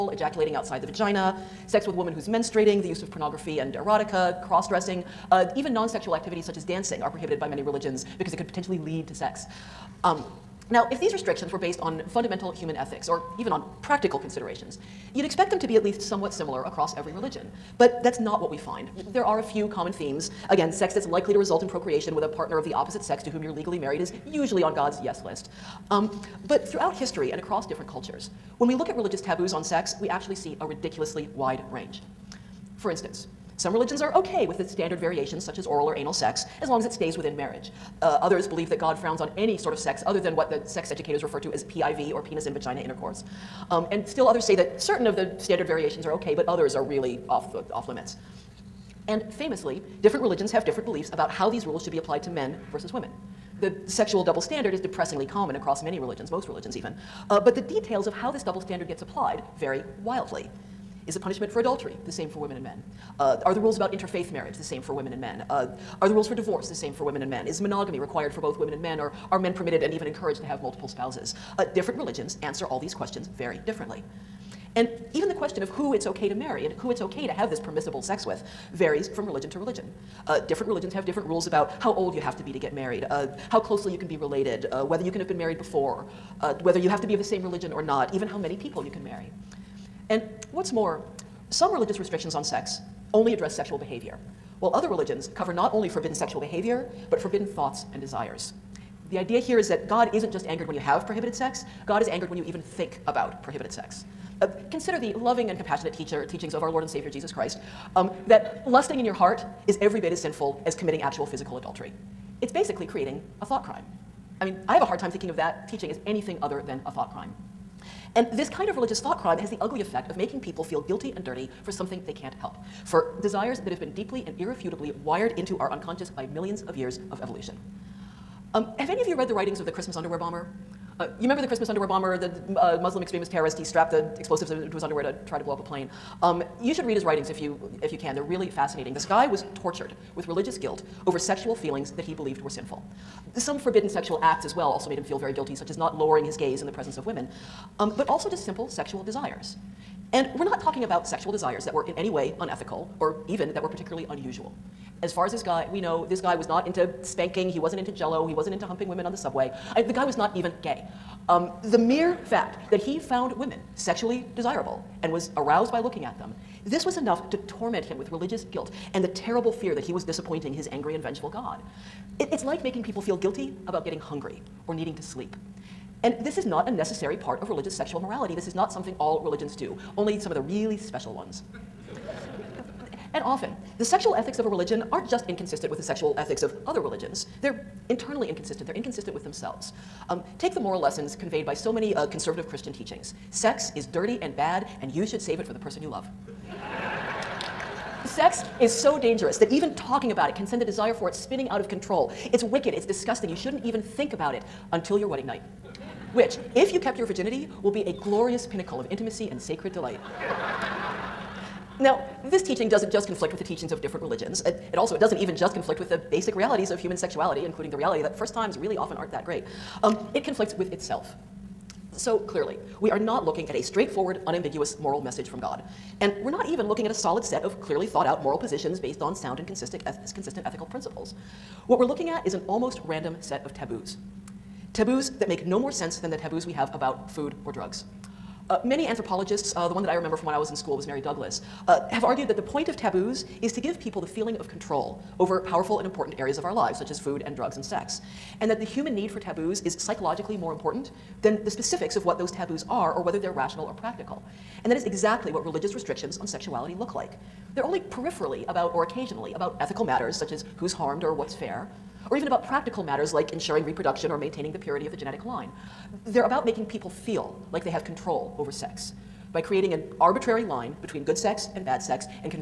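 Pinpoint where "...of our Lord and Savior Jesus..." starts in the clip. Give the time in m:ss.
1:46.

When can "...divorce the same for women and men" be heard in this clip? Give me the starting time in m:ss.
1:06.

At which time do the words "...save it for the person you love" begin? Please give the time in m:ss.
3:15.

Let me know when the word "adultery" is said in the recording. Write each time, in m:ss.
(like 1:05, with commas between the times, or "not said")
1:01, 1:51.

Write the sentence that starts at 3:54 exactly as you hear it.
Taboos that make no more sense than the taboos we have about food or drugs.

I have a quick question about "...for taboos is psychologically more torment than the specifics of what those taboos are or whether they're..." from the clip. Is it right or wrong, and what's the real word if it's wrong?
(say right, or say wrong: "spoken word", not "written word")
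wrong: "important", not "torment".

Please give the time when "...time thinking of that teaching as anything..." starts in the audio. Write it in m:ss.
1:54.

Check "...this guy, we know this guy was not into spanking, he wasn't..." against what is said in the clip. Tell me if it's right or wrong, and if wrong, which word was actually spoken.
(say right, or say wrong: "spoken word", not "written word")
right.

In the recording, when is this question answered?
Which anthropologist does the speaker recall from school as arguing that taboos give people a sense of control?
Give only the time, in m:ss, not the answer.
4:00.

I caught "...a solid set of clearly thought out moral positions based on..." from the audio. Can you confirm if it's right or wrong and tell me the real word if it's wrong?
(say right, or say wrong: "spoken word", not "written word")
right.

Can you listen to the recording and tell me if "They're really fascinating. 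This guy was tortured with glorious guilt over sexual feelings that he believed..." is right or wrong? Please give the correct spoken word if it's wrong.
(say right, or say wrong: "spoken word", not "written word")
wrong: "religious", not "glorious".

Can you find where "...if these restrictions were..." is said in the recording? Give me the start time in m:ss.
0:10.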